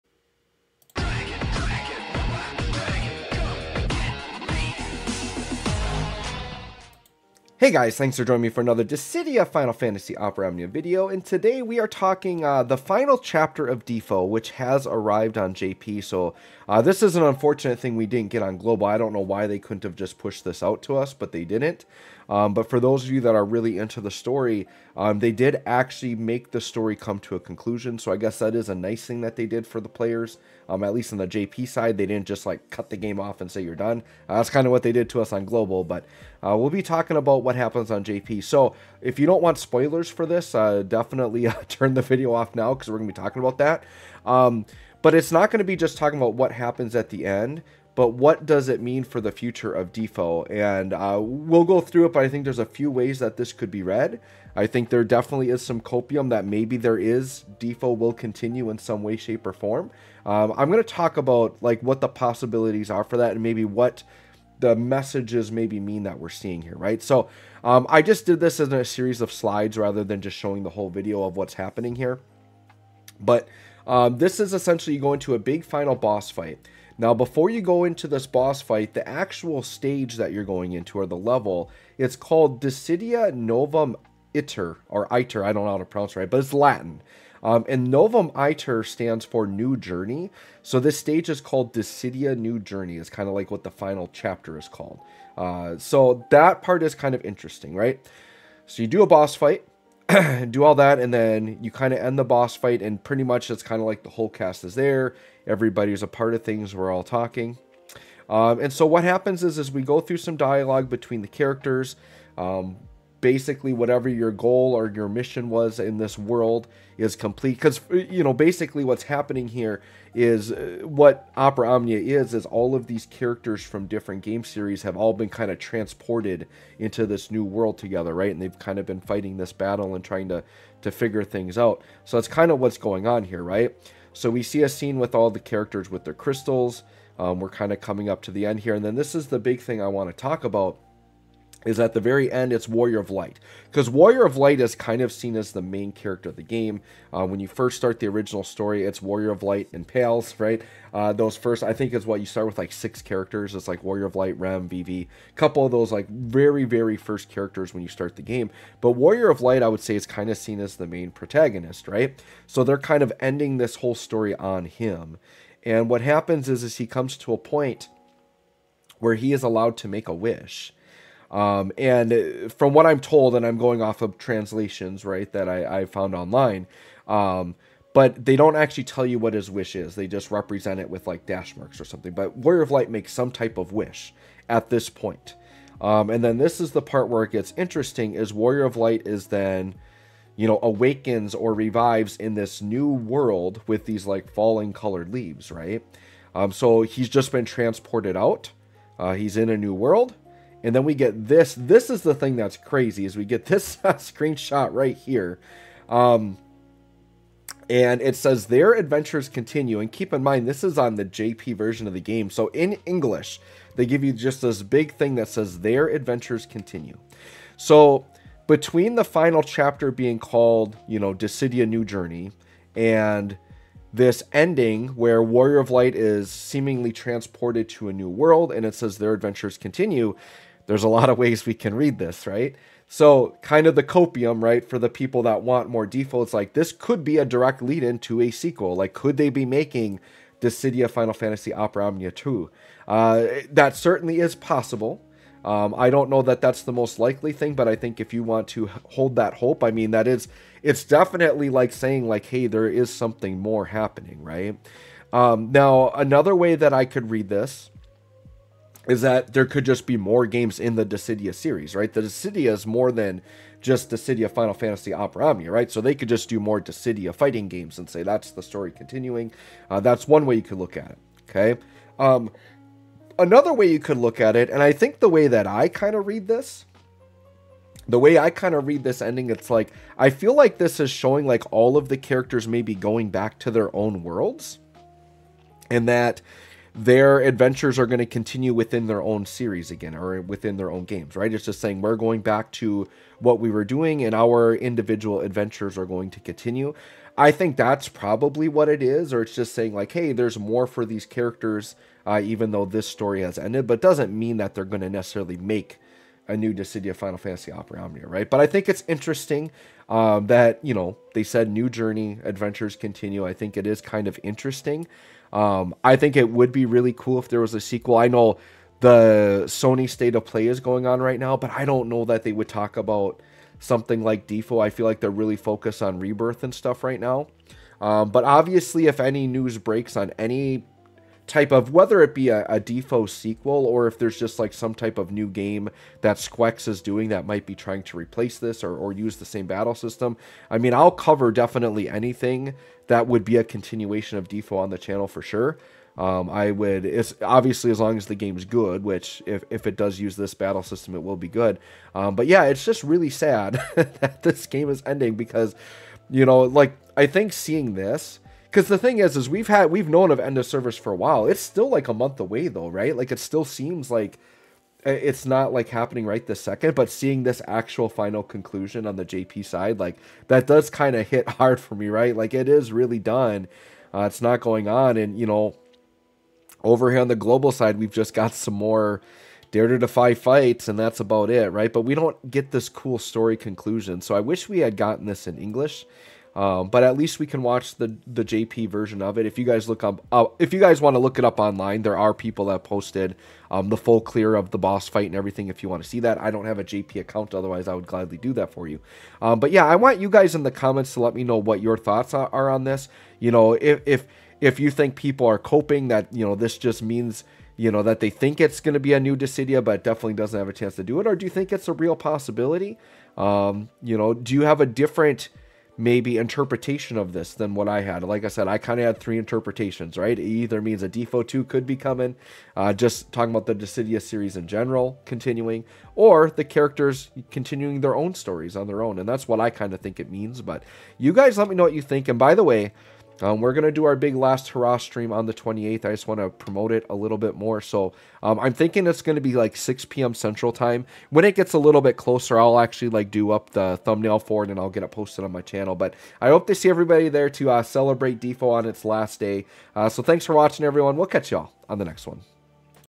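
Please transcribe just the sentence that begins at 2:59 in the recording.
They just represent it with like dash marks or something.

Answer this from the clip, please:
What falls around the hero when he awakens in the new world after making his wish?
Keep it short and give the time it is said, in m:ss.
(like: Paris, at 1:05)
Colored leaves, at 3:14.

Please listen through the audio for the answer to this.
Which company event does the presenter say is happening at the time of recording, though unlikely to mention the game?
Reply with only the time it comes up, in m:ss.
5:19.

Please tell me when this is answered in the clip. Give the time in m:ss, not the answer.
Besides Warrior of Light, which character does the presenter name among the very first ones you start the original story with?
2:34.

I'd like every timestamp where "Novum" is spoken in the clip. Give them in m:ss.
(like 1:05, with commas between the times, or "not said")
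1:23, 1:27.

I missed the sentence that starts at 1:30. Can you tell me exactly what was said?
So this stage is called Dissidia New Journey.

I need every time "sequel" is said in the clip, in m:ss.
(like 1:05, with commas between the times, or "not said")
3:58, 5:17, 5:33.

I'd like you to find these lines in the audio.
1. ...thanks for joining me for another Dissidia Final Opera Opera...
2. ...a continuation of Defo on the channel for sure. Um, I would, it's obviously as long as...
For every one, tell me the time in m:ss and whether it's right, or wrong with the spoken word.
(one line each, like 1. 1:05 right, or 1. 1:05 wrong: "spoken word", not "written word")
1. 0:07 wrong: "Fantasy", not "Opera"
2. 5:43 right.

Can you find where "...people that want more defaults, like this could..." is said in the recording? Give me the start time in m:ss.
3:54.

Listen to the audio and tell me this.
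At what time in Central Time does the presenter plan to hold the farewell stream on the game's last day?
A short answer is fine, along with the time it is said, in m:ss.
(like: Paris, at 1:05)
6 p.m., at 7:19.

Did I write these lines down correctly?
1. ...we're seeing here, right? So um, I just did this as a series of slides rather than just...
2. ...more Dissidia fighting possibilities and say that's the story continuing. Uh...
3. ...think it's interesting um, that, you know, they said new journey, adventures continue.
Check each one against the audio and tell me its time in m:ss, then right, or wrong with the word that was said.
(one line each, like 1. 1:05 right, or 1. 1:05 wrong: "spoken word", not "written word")
1. 1:06 right
2. 4:26 wrong: "games", not "possibilities"
3. 5:08 right.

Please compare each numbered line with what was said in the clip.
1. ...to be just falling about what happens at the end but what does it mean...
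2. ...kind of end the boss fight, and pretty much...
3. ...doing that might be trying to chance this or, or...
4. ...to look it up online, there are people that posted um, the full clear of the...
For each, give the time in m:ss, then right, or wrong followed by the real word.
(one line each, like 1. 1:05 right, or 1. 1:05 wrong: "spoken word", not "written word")
1. 0:45 wrong: "talking", not "falling"
2. 1:41 right
3. 5:36 wrong: "replace", not "chance"
4. 6:30 right.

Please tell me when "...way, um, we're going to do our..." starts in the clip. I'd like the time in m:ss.
7:12.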